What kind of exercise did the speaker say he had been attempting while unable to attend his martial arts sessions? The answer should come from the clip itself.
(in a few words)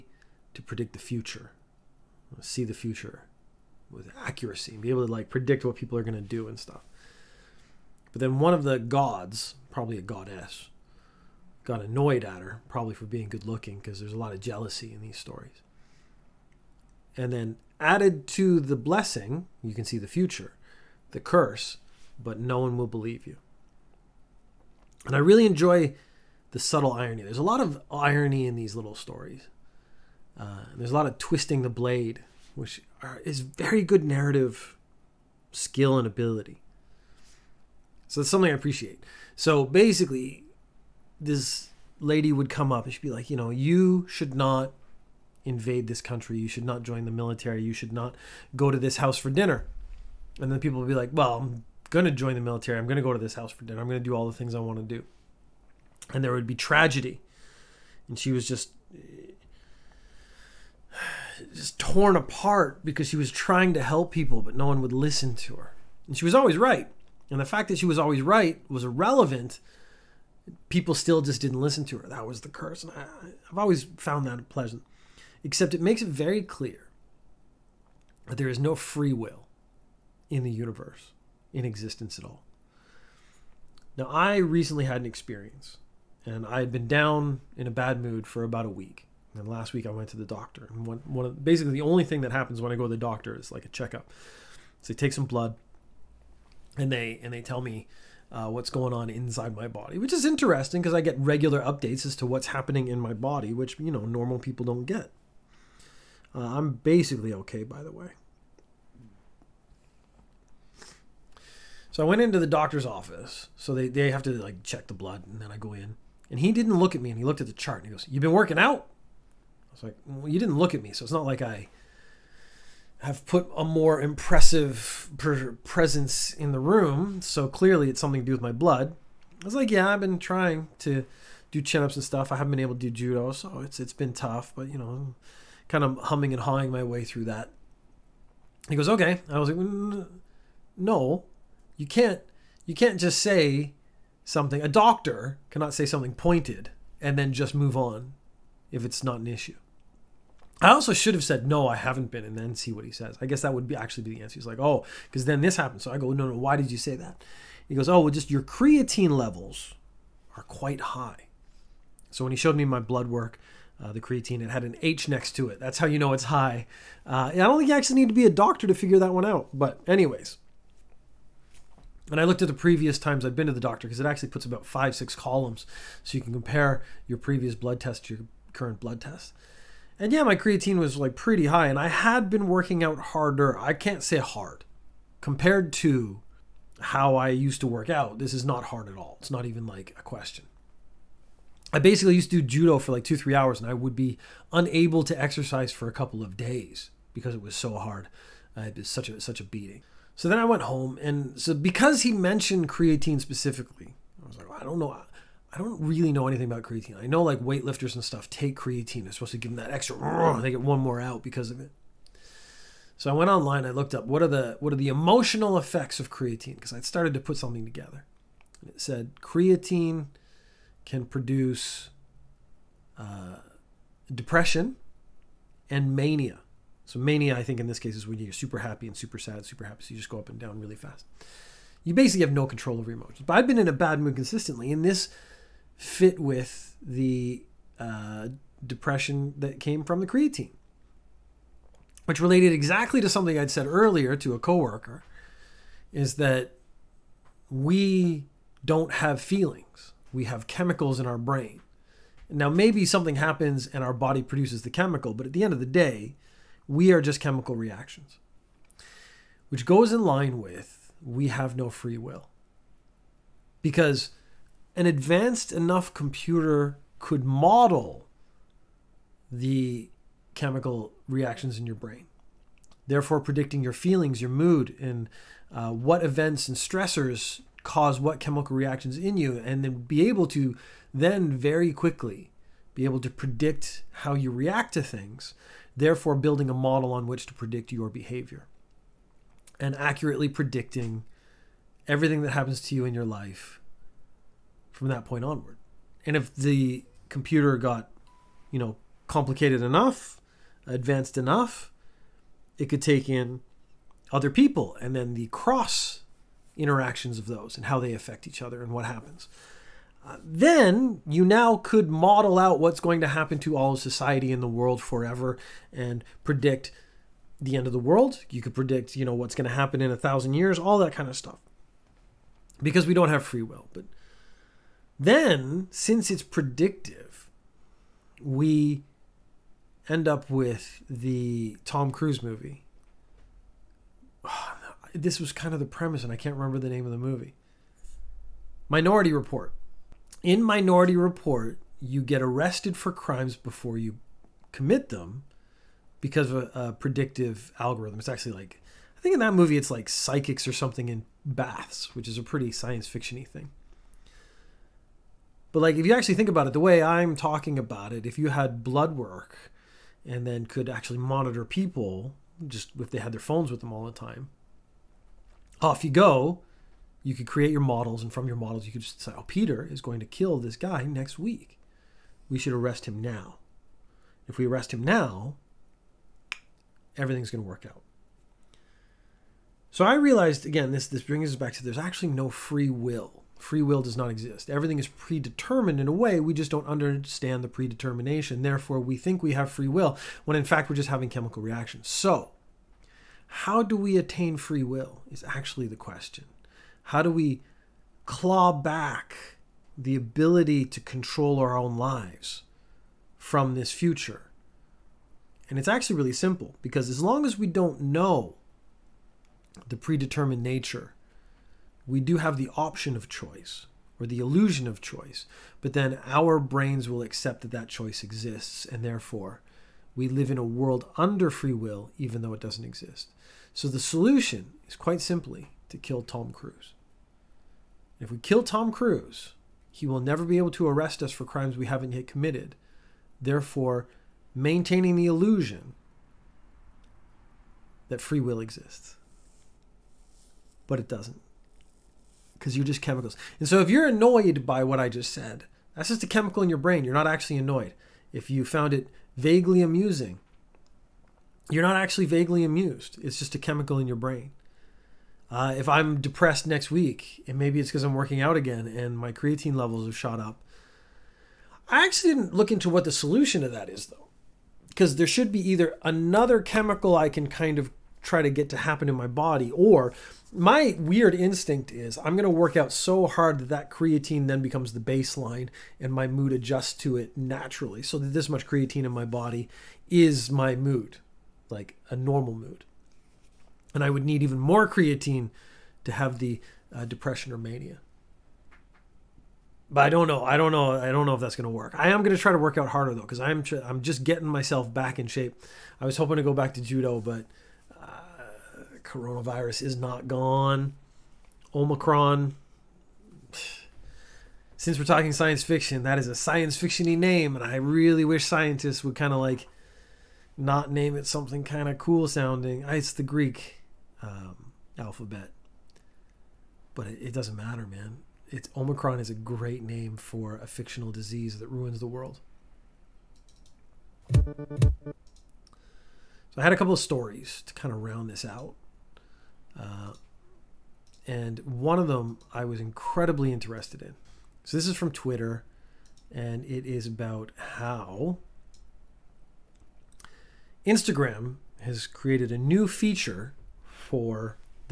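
Chin-ups.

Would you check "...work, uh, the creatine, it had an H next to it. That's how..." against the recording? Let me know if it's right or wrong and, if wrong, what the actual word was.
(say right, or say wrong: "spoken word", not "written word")
right.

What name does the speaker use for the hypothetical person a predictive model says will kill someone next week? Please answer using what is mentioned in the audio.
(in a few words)
Peter.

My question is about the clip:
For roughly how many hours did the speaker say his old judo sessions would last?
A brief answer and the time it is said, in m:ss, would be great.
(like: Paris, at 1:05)
2 to 3 hours, at 3:13.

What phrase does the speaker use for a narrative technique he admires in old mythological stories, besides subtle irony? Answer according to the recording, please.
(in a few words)
Twisting the blade.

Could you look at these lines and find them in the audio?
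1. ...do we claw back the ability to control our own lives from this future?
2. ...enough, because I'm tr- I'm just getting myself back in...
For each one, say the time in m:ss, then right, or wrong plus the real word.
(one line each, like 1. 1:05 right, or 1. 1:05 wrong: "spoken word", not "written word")
1. 6:37 right
2. 8:12 wrong: "though", not "enough".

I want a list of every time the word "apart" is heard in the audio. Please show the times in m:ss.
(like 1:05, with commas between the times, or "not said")
1:02.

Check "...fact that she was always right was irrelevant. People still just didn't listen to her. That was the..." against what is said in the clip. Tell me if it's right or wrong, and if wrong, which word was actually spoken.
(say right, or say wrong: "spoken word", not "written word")
right.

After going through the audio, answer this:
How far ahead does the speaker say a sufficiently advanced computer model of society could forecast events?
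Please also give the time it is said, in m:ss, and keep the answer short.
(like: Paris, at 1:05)
1000 years, at 5:19.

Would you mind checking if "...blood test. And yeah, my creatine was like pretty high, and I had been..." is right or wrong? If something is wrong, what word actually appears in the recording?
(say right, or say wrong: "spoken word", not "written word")
right.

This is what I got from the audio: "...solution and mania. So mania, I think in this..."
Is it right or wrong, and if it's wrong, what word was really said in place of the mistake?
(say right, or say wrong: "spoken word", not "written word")
wrong: "depression", not "solution".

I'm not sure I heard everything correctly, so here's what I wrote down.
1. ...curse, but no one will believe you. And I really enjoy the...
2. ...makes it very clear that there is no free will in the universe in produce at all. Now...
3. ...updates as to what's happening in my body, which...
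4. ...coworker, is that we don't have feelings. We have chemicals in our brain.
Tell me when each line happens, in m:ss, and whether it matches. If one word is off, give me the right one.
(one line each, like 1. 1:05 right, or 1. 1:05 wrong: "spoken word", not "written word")
1. 0:21 right
2. 1:15 wrong: "existence", not "produce"
3. 1:41 right
4. 4:04 right.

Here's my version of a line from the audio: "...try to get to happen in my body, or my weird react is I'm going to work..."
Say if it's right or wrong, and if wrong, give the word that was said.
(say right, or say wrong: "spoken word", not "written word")
wrong: "instinct", not "react".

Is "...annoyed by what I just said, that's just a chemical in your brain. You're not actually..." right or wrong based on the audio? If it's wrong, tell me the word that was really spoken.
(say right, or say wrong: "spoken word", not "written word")
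right.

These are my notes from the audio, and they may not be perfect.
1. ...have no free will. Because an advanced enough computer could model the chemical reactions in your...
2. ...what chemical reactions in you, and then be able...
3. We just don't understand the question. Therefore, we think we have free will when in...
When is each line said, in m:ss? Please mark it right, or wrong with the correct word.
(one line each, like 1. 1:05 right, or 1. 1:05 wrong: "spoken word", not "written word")
1. 4:21 right
2. 4:37 right
3. 6:26 wrong: "predetermination", not "question".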